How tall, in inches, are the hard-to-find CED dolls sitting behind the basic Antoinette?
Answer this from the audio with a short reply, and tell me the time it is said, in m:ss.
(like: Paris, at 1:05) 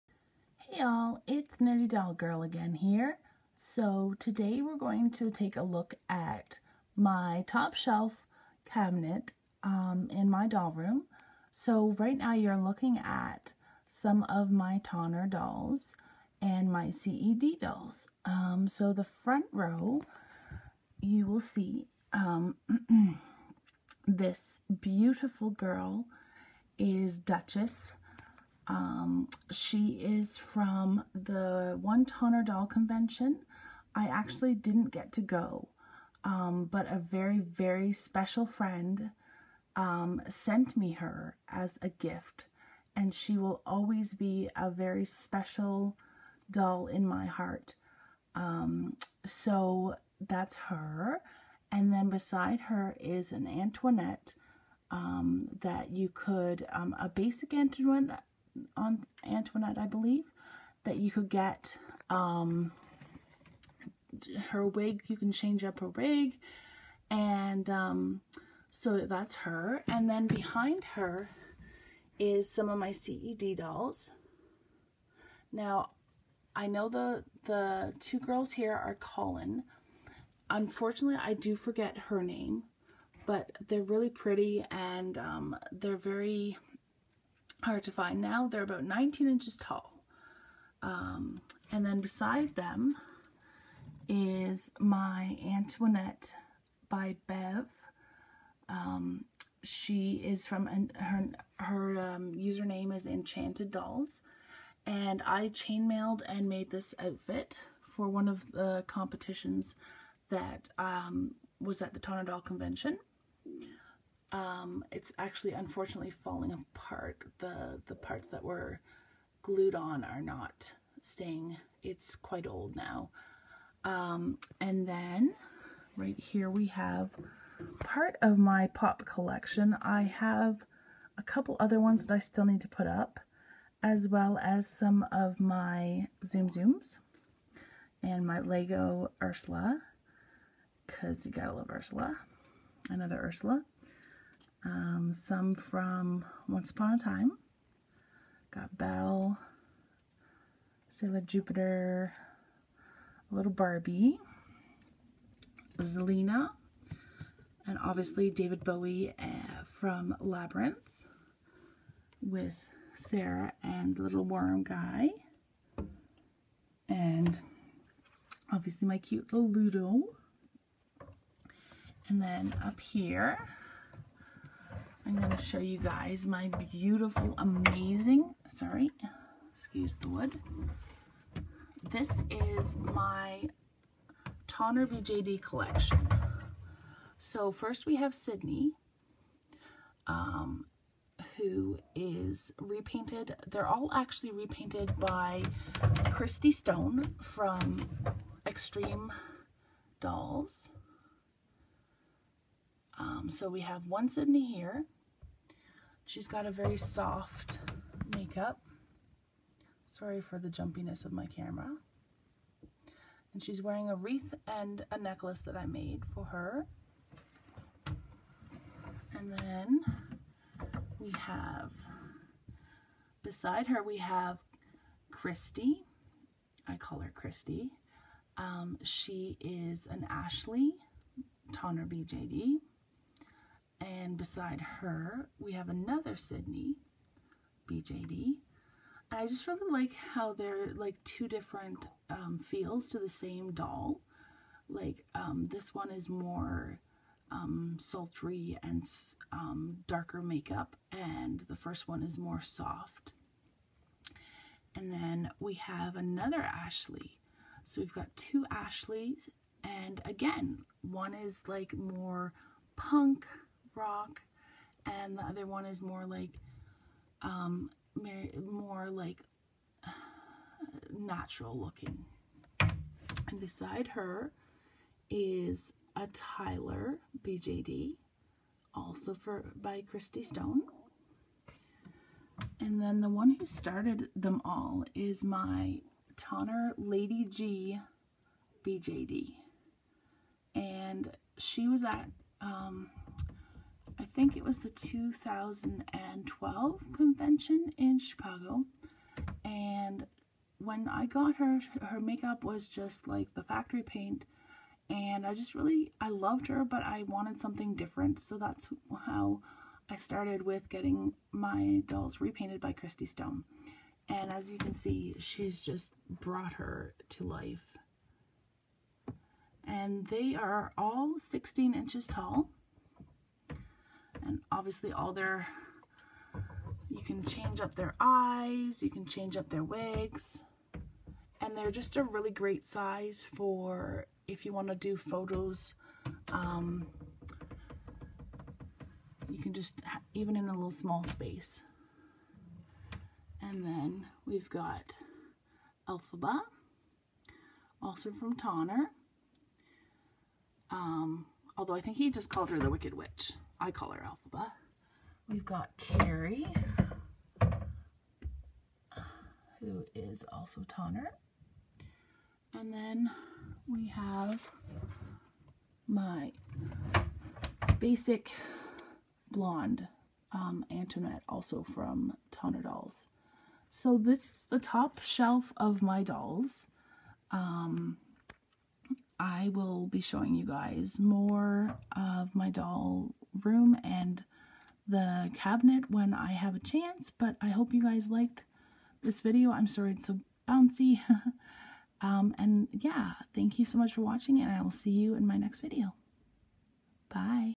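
19 inches, at 1:28.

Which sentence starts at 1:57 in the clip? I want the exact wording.
The, the parts that were glued on are not staying.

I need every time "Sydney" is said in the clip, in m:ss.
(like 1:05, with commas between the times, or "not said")
3:08, 3:24, 3:56.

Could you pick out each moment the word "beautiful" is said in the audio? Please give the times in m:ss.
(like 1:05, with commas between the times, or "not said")
0:24, 2:56.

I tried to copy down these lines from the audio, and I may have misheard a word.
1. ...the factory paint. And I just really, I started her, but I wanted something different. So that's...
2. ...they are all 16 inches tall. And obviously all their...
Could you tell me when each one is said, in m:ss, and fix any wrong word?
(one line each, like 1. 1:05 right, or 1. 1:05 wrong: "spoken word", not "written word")
1. 5:03 wrong: "loved", not "started"
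2. 5:20 right.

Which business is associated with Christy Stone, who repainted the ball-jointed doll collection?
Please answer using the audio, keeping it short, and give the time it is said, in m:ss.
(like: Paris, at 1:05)
Extreme Dolls, at 3:18.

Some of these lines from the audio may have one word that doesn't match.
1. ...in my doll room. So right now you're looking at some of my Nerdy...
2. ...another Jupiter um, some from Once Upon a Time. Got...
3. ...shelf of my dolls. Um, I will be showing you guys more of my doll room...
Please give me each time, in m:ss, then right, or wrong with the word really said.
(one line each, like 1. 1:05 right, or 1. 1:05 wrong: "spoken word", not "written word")
1. 0:10 wrong: "Tonner", not "Nerdy"
2. 2:22 wrong: "Ursula", not "Jupiter"
3. 6:15 right.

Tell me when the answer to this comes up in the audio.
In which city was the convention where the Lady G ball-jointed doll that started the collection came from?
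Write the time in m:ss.
4:57.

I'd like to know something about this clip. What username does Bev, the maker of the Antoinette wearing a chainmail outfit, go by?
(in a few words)
Enchanted Dolls.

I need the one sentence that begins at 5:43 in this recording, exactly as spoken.
And then we've got Elphaba, also from Tonner.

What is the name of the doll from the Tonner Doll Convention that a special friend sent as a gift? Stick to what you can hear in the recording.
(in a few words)
Duchess.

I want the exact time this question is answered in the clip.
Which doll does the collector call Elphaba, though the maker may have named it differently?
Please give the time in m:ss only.
5:52.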